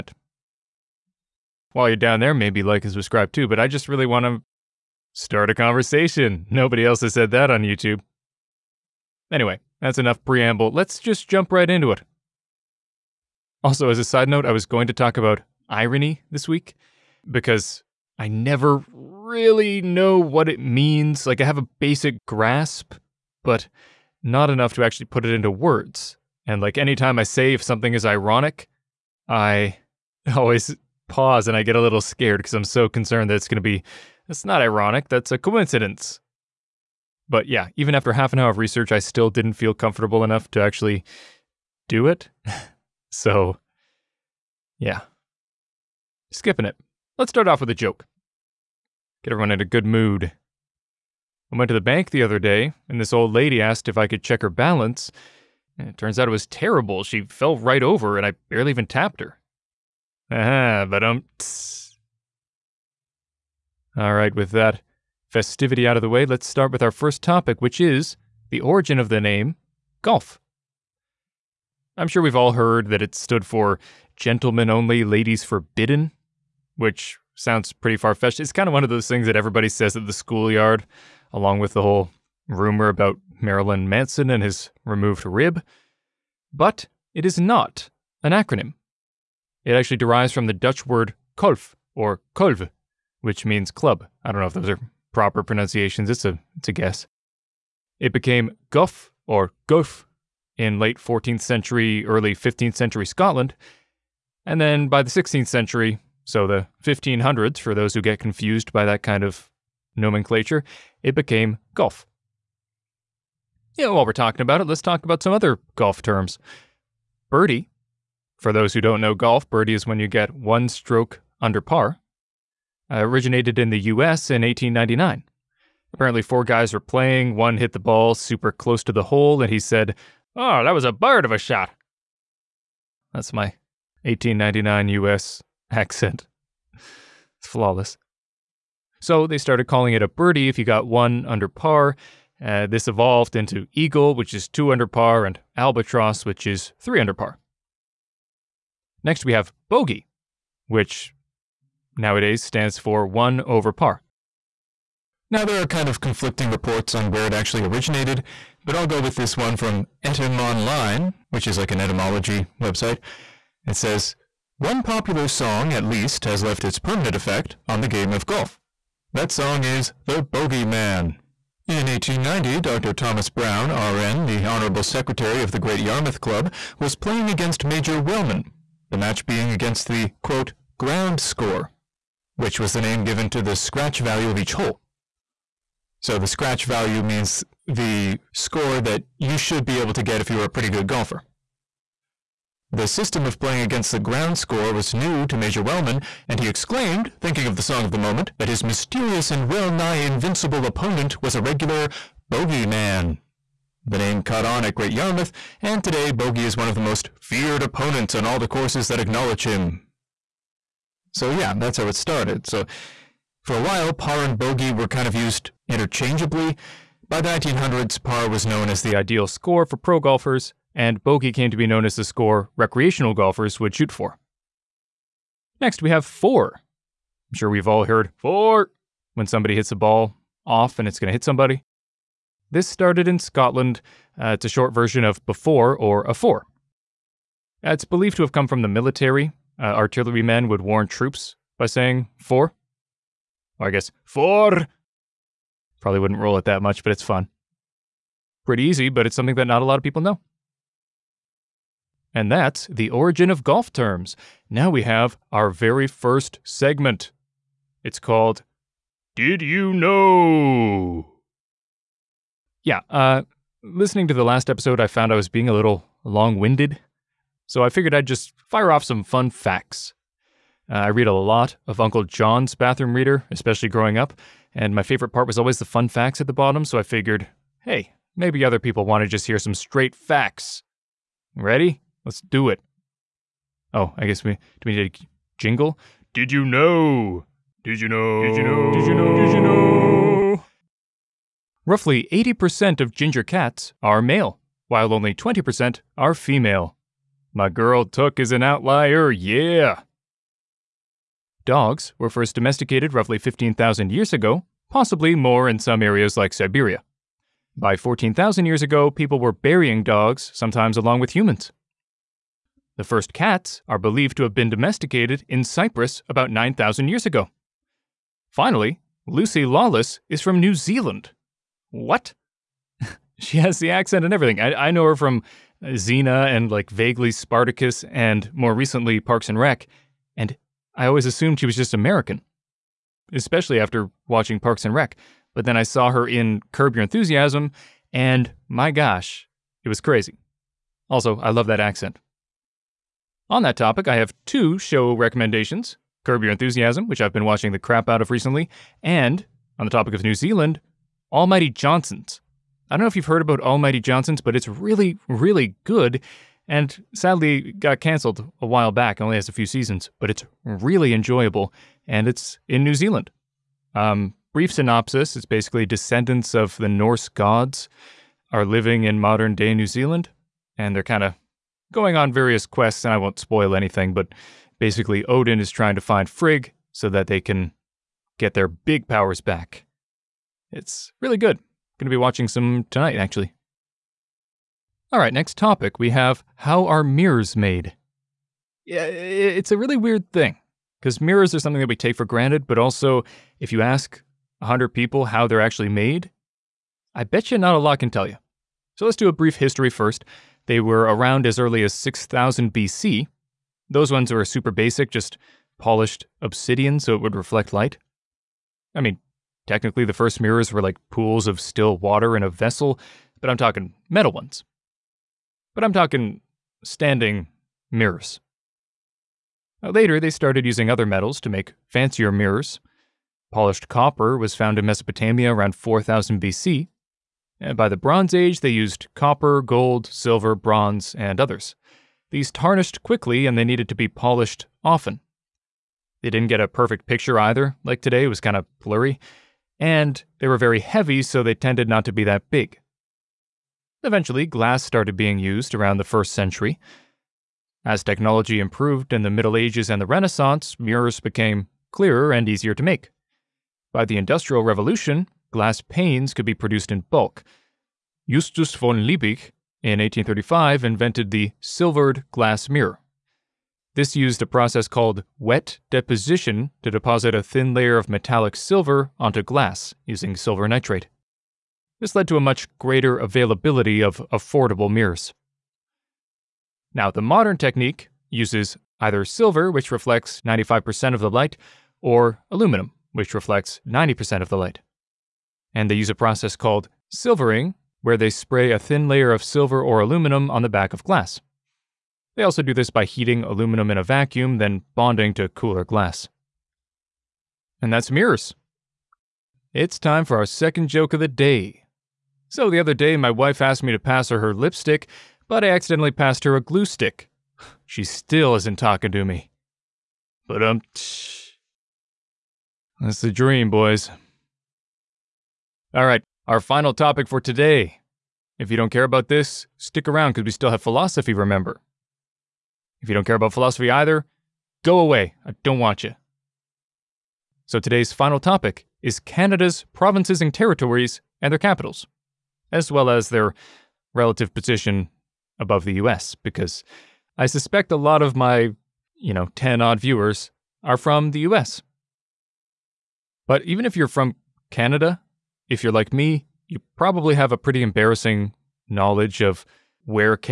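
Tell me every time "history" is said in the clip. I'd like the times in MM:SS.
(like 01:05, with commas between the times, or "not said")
06:39.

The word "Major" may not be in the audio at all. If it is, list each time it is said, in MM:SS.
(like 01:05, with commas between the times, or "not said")
02:57, 03:15.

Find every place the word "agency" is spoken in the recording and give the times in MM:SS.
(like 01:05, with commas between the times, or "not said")
not said.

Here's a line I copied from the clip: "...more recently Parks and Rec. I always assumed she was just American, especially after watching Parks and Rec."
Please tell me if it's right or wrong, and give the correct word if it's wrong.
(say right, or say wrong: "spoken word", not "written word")
right.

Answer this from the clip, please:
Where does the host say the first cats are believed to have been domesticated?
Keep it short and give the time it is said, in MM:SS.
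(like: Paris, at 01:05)
Cyprus, at 05:15.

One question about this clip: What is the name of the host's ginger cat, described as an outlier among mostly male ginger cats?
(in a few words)
Took.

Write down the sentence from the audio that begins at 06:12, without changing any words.
And I won't spoil anything, but basically Odin is trying to find Frigg so that they can get their big powers back.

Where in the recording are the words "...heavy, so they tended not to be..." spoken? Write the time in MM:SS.
07:20.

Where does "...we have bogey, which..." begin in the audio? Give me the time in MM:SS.
02:29.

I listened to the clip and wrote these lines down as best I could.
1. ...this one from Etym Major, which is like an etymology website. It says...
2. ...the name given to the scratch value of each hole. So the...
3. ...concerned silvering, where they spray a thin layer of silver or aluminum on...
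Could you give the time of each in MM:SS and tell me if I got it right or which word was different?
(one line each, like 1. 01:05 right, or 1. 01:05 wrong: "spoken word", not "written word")
1. 02:39 wrong: "Online", not "Major"
2. 03:02 right
3. 08:06 wrong: "called", not "concerned".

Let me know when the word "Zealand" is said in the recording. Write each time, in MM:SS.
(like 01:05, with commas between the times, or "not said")
05:20, 05:50, 06:02, 06:09.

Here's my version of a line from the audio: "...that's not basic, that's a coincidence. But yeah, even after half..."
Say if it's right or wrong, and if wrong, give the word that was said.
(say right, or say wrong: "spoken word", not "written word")
wrong: "ironic", not "basic".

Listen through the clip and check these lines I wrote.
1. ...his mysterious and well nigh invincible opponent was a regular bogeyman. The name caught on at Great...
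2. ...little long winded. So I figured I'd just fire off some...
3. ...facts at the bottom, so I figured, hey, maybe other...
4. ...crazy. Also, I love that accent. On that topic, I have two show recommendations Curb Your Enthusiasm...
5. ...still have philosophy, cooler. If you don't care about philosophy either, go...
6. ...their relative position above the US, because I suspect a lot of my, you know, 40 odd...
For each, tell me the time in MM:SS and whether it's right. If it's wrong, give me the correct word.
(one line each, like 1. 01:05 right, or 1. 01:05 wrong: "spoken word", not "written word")
1. 03:18 right
2. 04:25 right
3. 04:35 right
4. 05:39 right
5. 08:40 wrong: "remember", not "cooler"
6. 08:53 wrong: "10", not "40".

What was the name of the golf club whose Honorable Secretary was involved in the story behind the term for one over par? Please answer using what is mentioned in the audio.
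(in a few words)
Great Yarmouth Club.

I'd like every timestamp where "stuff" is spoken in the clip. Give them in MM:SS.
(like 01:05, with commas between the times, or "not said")
not said.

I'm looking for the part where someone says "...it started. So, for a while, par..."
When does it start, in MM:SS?
03:31.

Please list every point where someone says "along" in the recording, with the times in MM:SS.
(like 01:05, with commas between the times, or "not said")
01:21, 05:10.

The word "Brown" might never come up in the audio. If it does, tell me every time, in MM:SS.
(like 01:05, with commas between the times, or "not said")
02:53.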